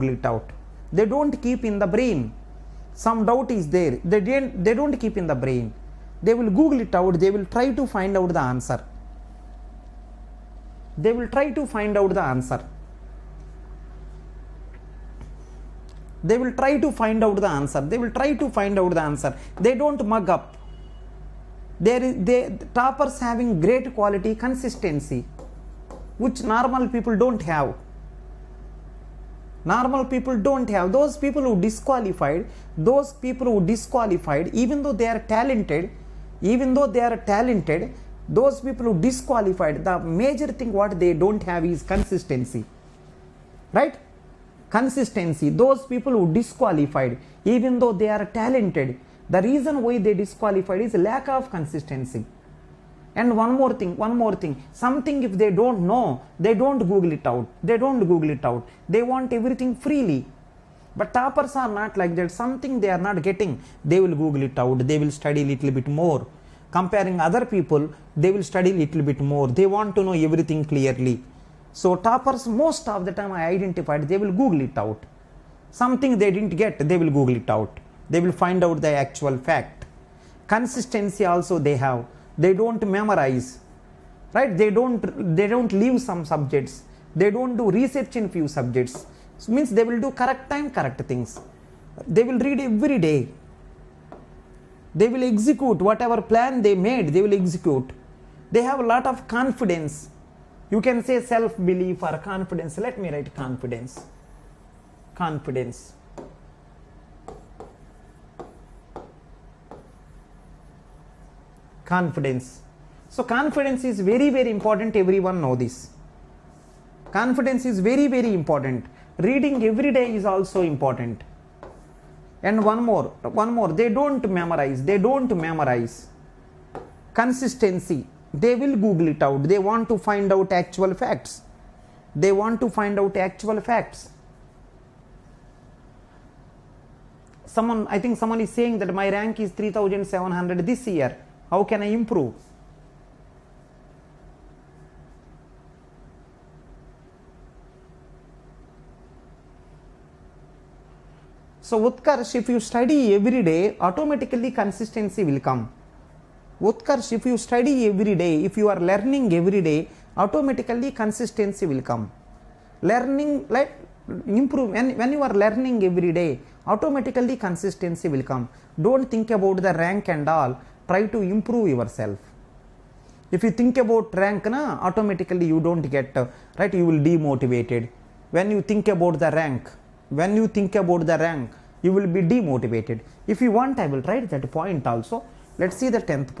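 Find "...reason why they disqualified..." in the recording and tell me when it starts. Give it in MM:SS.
00:49.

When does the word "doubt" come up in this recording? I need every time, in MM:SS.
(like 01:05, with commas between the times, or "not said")
00:03.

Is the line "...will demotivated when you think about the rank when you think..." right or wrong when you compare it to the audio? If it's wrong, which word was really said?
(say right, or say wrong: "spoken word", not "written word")
right.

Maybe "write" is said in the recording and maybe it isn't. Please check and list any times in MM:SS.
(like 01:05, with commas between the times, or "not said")
01:43, 03:04.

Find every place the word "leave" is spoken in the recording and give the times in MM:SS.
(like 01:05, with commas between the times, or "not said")
01:25.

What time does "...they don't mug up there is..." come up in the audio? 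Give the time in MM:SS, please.
00:19.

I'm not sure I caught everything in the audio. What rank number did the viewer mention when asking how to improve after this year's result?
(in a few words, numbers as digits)
3700.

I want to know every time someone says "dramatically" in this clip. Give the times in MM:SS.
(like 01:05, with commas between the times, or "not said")
not said.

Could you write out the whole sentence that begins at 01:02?
Something they are not getting, they will Google it out.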